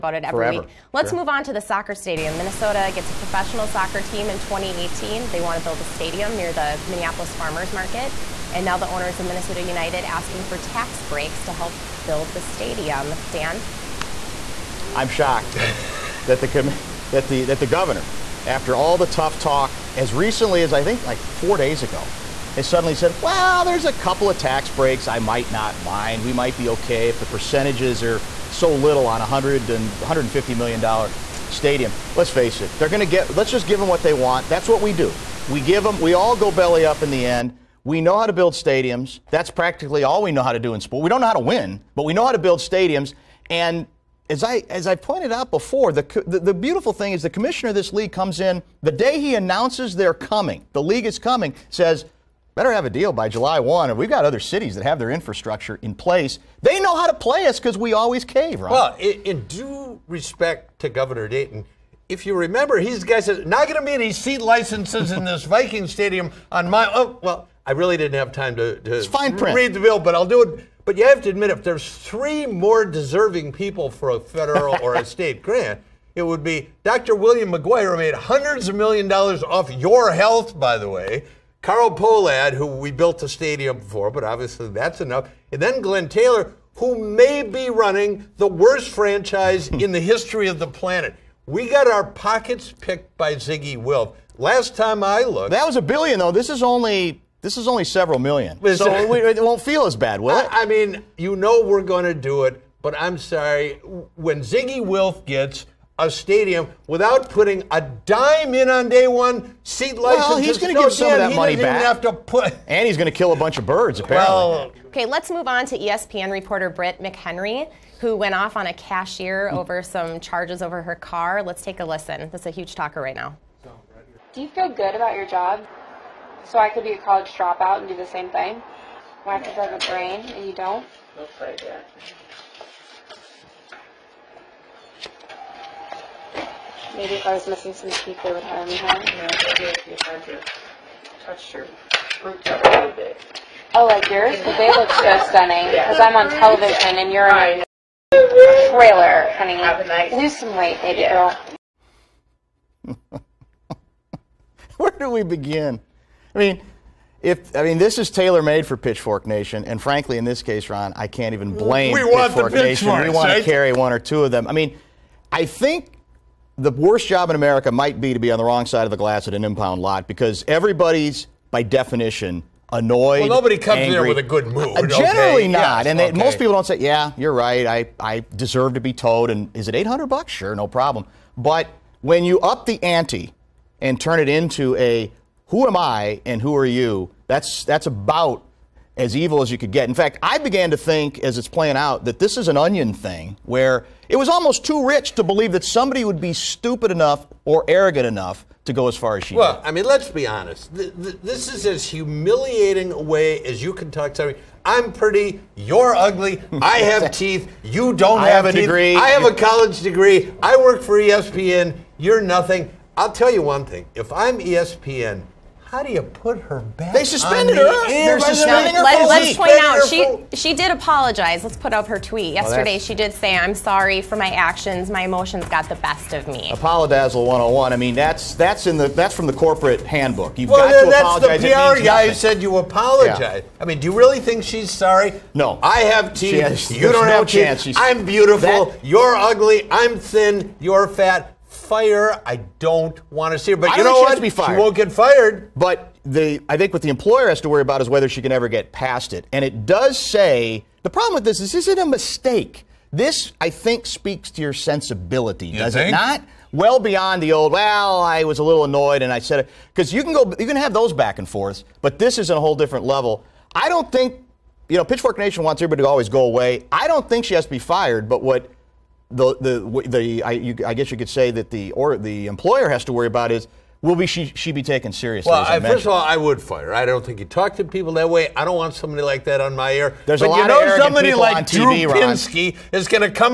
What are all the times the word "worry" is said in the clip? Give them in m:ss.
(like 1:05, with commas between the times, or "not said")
4:07, 4:32.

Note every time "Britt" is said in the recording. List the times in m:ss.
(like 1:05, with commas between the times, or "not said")
1:56.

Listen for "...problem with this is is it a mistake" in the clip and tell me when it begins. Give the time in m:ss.
4:10.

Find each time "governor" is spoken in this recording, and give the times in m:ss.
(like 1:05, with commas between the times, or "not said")
0:17, 1:00.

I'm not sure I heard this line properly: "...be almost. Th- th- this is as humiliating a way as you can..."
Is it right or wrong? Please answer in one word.
wrong.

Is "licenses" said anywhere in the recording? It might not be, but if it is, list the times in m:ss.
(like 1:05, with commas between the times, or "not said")
1:04, 1:49.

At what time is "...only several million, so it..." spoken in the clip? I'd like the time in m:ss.
1:37.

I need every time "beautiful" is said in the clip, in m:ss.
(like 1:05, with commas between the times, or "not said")
0:46, 3:58.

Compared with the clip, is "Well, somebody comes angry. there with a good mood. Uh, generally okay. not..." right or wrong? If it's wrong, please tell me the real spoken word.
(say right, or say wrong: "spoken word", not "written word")
wrong: "nobody", not "somebody".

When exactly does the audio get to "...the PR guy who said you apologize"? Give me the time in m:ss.
3:51.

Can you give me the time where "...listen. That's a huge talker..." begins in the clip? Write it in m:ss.
2:01.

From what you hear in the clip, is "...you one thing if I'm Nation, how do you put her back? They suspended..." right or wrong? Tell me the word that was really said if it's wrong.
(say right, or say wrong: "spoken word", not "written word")
wrong: "ESPN", not "Nation".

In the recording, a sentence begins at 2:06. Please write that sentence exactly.
So I could be a college dropout and do the same thing.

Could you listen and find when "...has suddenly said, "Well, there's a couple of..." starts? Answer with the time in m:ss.
0:22.